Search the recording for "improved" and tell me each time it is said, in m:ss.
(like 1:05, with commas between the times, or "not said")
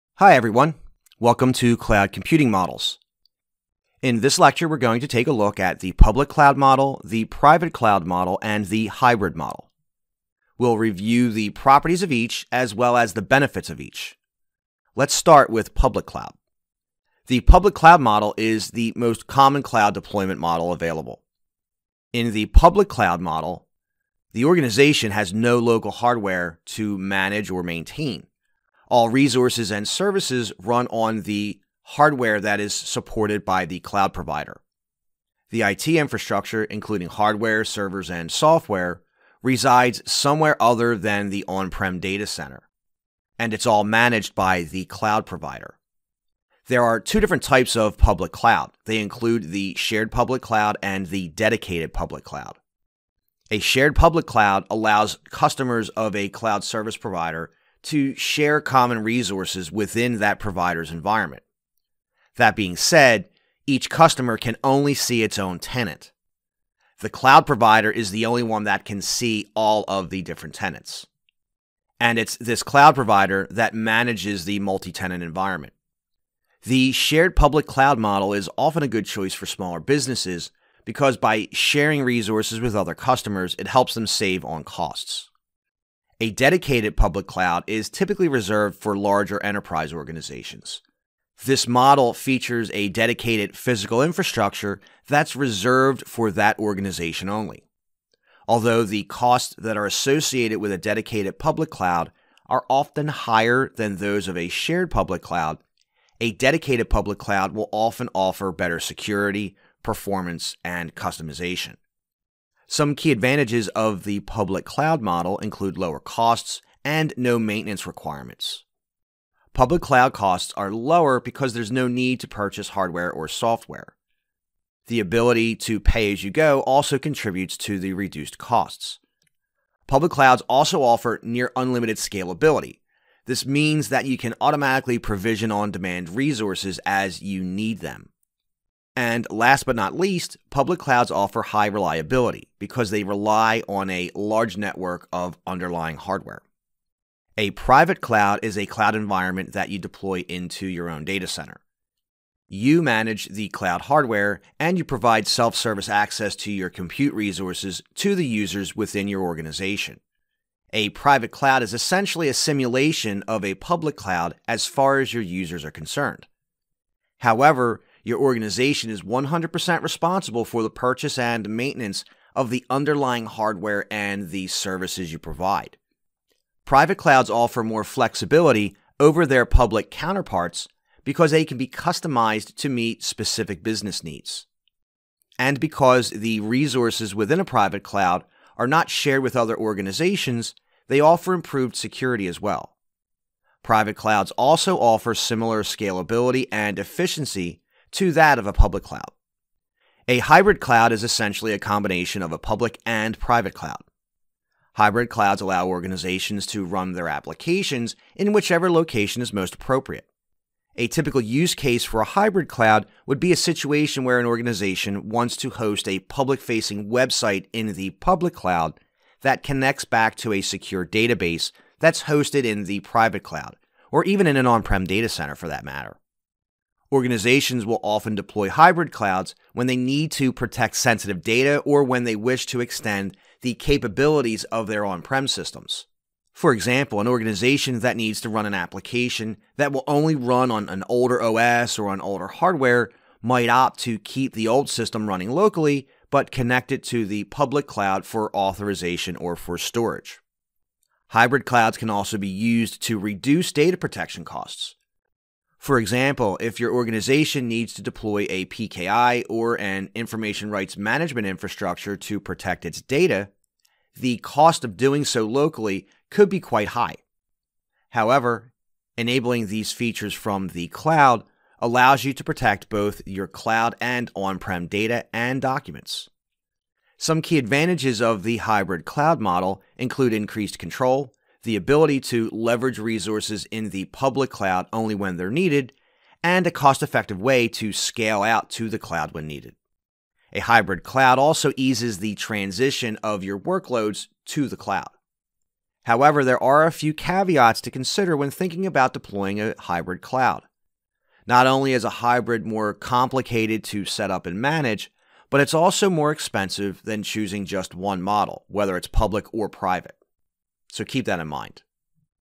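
3:11.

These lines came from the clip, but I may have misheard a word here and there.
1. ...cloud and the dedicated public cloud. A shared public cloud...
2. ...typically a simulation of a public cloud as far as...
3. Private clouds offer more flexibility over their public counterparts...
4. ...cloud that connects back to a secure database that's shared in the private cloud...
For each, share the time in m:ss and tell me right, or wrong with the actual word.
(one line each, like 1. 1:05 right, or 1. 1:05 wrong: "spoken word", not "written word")
1. 0:50 right
2. 2:41 wrong: "essentially", not "typically"
3. 2:56 right
4. 3:38 wrong: "hosted", not "shared".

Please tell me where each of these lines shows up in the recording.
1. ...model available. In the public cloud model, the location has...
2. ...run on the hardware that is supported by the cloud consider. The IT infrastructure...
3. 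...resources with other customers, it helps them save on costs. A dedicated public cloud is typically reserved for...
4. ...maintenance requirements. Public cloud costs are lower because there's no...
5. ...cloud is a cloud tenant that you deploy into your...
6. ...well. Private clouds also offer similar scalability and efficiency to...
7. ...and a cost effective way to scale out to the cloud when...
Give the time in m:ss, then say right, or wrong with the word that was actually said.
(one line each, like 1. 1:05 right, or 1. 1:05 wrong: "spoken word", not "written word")
1. 0:20 wrong: "organization", not "location"
2. 0:30 wrong: "provider", not "consider"
3. 1:22 right
4. 1:57 right
5. 2:28 wrong: "environment", not "tenant"
6. 3:12 right
7. 4:46 right.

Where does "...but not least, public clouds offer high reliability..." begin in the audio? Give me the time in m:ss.
2:19.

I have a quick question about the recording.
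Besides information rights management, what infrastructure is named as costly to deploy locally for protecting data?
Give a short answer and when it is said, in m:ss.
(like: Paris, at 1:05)
PKI, at 4:18.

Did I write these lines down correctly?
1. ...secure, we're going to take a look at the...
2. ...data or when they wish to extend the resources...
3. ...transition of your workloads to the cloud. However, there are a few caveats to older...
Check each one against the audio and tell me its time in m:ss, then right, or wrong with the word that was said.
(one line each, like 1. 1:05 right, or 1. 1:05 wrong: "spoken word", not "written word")
1. 0:04 wrong: "lecture", not "secure"
2. 3:51 wrong: "capabilities", not "resources"
3. 4:52 wrong: "consider", not "older".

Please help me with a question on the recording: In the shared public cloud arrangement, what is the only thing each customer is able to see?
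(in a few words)
Its own tenant.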